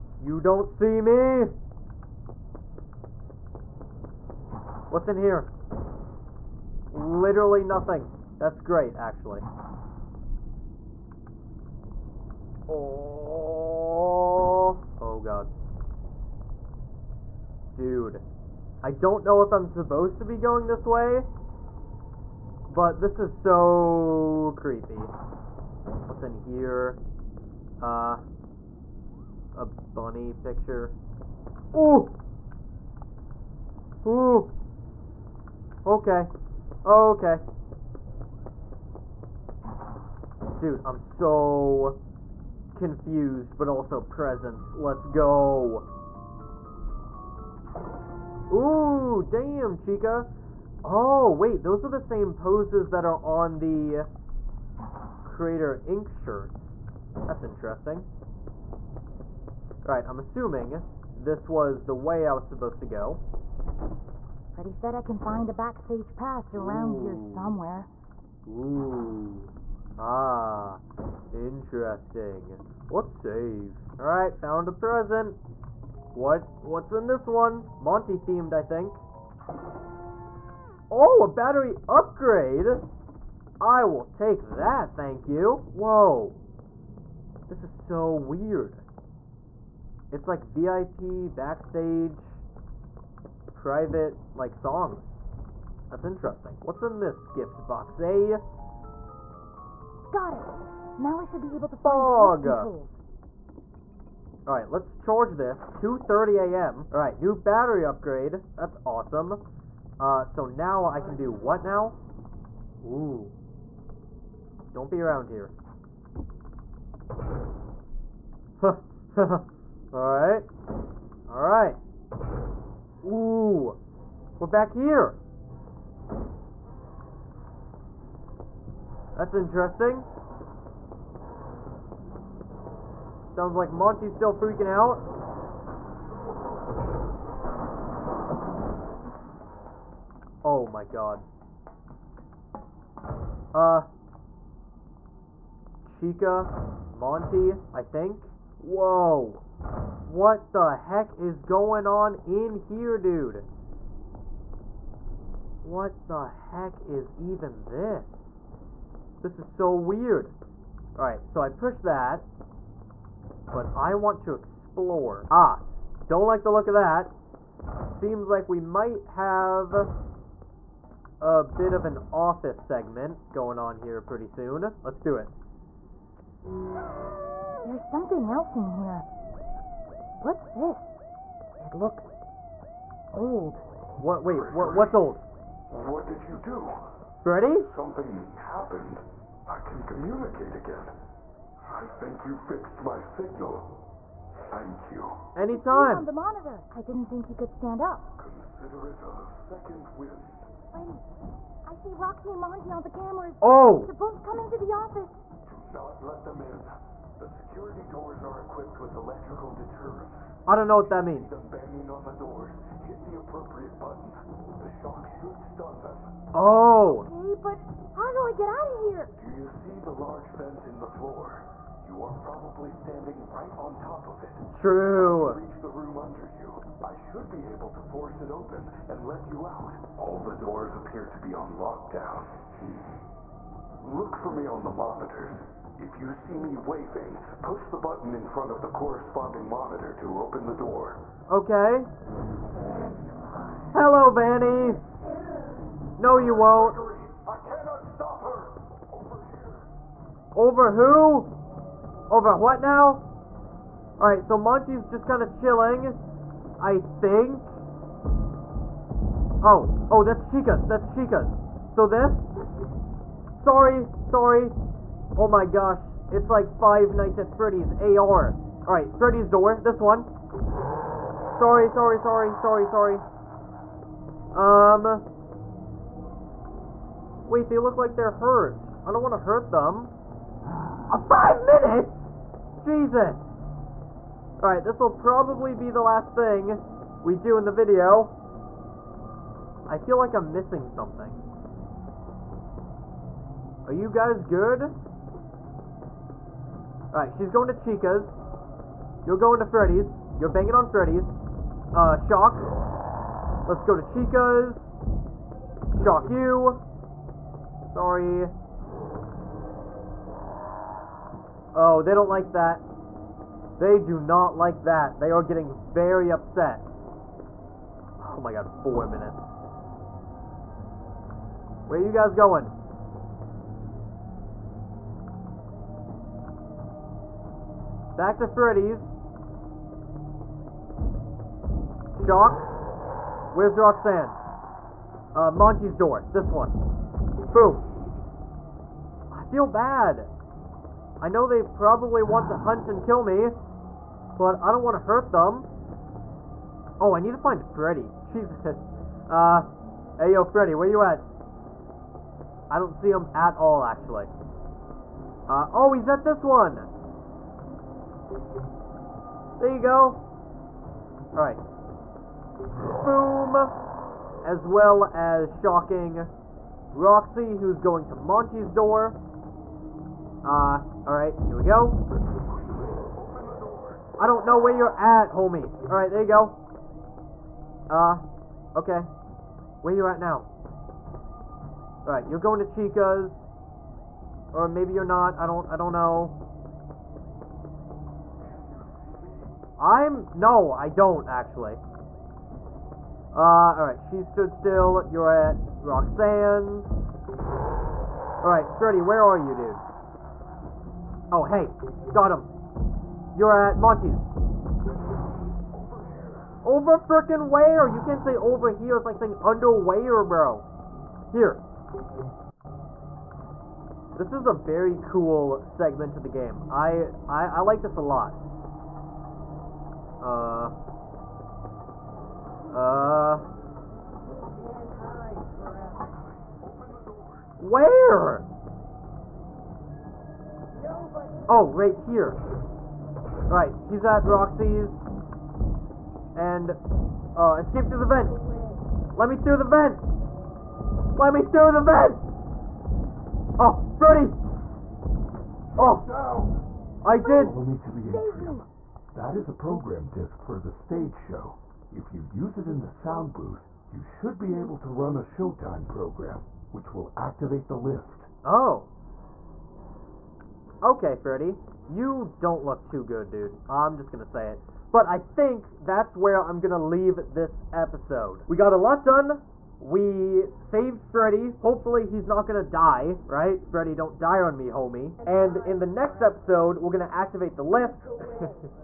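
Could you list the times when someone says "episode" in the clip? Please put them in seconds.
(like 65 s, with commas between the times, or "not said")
467 s, 476 s.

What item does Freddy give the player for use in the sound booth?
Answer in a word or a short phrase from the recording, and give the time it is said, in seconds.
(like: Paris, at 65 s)
A program disc, at 449 s.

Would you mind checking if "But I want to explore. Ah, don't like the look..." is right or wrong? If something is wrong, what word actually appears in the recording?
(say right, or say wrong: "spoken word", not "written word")
right.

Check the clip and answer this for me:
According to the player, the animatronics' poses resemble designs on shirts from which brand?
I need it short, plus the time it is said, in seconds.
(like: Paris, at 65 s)
Creator ink, at 55 s.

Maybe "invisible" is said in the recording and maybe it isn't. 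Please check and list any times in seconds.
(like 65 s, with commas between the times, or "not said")
not said.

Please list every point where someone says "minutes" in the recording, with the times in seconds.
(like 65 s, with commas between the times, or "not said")
281 s, 318 s.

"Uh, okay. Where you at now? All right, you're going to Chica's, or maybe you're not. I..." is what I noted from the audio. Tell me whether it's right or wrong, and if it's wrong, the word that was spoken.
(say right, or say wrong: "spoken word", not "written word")
right.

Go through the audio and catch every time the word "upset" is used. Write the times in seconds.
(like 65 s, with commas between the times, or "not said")
316 s.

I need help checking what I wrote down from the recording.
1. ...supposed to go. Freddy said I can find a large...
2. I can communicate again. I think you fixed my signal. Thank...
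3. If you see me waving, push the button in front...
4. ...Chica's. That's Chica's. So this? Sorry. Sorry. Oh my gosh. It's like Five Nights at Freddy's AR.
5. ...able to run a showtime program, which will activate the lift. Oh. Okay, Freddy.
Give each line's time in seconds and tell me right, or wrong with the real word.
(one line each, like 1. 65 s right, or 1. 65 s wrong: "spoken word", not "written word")
1. 62 s wrong: "backstage", not "large"
2. 189 s right
3. 235 s right
4. 260 s right
5. 454 s right.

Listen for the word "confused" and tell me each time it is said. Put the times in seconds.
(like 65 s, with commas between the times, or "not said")
42 s.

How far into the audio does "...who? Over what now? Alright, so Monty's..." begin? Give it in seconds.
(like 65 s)
250 s.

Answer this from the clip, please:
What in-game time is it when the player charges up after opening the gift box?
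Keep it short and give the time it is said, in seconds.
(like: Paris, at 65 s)
2:30 a.m., at 105 s.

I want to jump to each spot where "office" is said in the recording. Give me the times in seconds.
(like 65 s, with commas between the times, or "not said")
172 s, 204 s.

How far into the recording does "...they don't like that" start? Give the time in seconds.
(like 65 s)
311 s.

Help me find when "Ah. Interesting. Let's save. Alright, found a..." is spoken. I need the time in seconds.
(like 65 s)
69 s.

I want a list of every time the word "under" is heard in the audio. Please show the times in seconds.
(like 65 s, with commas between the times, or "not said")
225 s, 409 s.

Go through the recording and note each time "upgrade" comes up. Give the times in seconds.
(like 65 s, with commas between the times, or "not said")
81 s, 107 s.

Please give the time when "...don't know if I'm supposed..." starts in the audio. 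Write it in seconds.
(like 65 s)
18 s.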